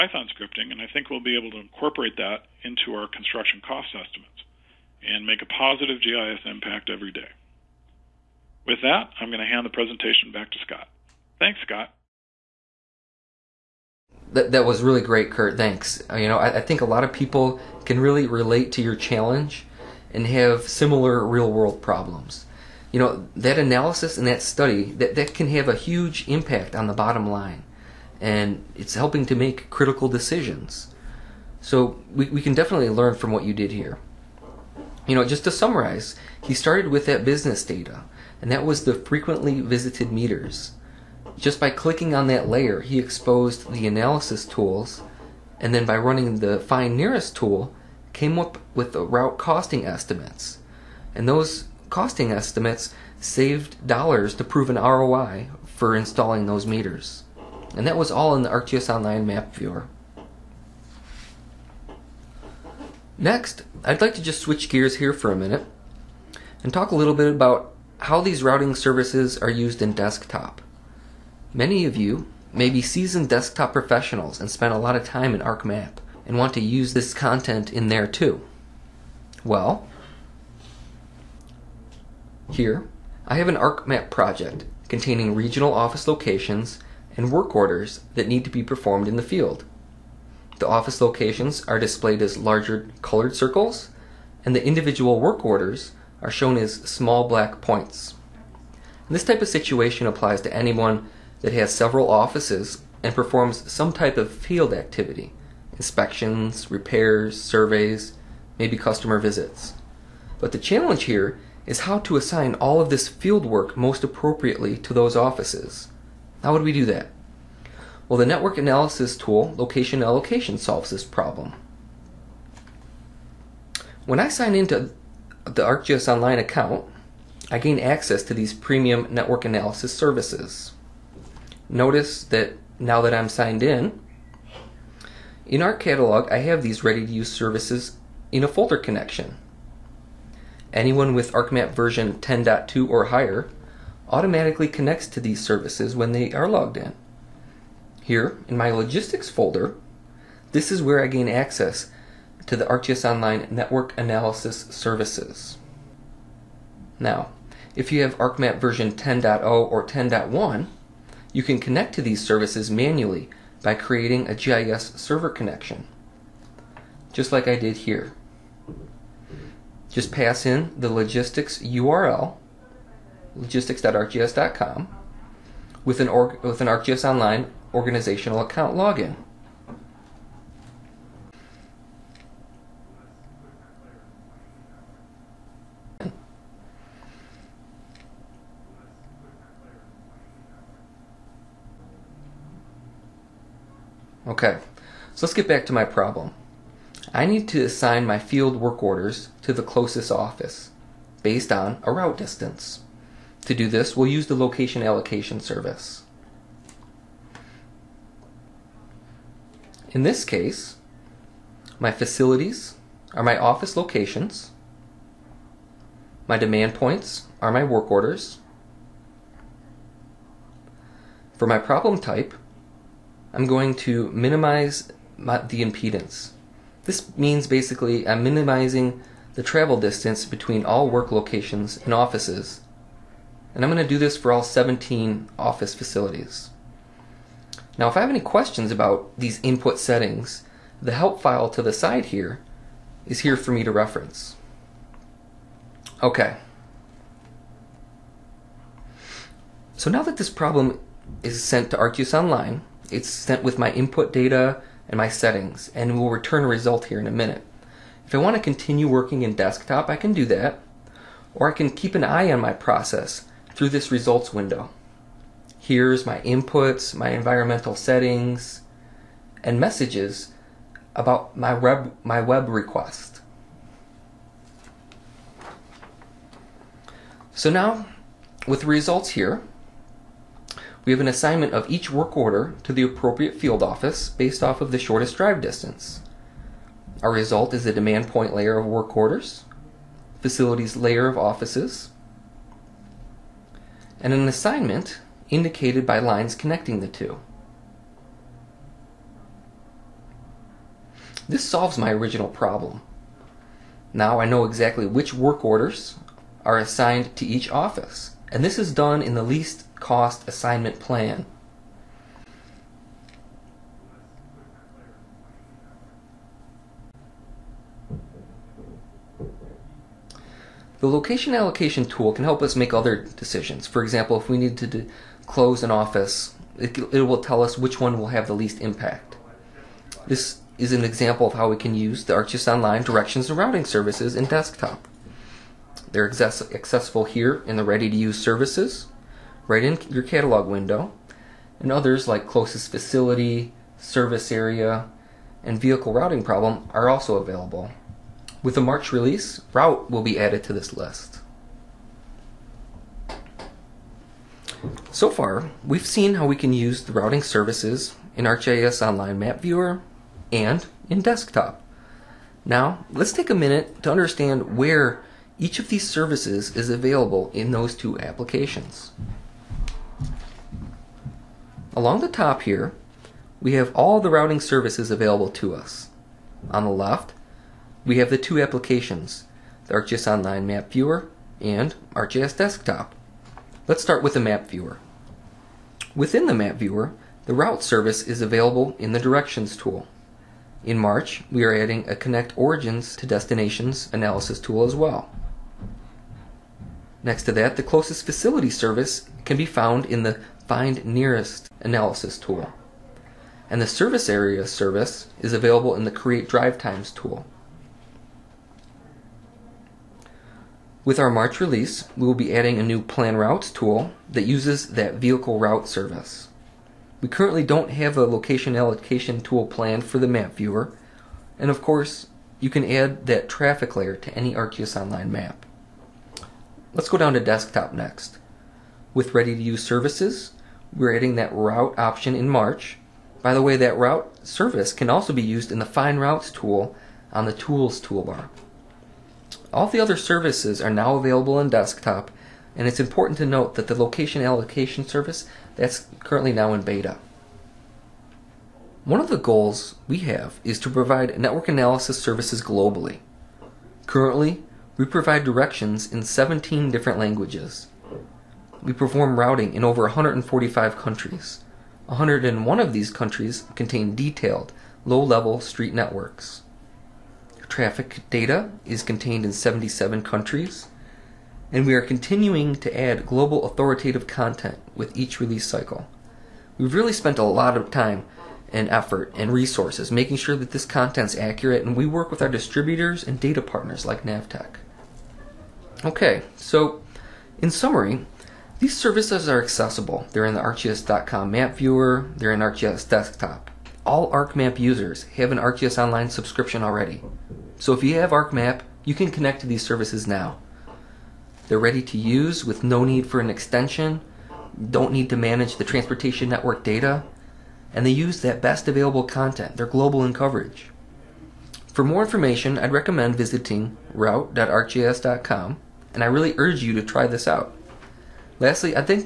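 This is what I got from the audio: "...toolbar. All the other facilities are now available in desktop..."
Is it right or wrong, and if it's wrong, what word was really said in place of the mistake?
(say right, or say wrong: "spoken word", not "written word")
wrong: "services", not "facilities".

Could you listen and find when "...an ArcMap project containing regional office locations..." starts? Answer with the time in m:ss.
1:23.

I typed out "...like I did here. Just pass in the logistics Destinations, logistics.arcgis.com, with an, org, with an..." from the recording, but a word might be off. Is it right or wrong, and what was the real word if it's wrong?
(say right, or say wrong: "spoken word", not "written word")
wrong: "URL", not "Destinations".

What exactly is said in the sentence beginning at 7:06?
Let's go down to desktop next.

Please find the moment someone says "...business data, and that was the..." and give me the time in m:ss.
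0:37.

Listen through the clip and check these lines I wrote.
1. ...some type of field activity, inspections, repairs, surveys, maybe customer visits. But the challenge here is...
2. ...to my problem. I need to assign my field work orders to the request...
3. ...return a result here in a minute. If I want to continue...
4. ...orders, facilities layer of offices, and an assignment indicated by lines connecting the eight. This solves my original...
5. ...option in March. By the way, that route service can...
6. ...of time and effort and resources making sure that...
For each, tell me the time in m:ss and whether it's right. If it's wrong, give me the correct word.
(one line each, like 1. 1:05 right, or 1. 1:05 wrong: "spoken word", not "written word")
1. 1:43 right
2. 3:15 wrong: "closest", not "request"
3. 4:16 right
4. 4:48 wrong: "two", not "eight"
5. 7:11 right
6. 7:57 right.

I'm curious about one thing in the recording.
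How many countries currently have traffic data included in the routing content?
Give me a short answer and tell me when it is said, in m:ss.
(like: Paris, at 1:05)
77, at 7:49.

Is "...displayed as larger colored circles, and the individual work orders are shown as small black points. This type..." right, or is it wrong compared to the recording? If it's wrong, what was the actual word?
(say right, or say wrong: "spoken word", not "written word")
right.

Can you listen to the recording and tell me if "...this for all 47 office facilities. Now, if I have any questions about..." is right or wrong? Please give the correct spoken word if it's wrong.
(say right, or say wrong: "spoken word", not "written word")
wrong: "17", not "47".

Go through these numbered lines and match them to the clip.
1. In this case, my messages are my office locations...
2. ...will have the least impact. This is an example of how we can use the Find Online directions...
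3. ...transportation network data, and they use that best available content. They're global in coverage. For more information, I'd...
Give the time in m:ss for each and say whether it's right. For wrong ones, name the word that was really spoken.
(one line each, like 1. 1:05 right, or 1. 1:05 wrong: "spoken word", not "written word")
1. 3:29 wrong: "facilities", not "messages"
2. 5:27 wrong: "ArcGIS", not "Find"
3. 8:25 right.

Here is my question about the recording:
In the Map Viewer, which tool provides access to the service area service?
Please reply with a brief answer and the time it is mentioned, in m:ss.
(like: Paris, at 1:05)
Create Drive Times, at 6:45.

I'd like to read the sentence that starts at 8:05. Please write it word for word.
Okay, so in summary, these services are accessible.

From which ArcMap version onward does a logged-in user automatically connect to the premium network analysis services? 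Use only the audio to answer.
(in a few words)
10.2.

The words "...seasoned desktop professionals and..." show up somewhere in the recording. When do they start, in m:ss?
1:12.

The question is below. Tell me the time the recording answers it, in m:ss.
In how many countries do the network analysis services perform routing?
7:39.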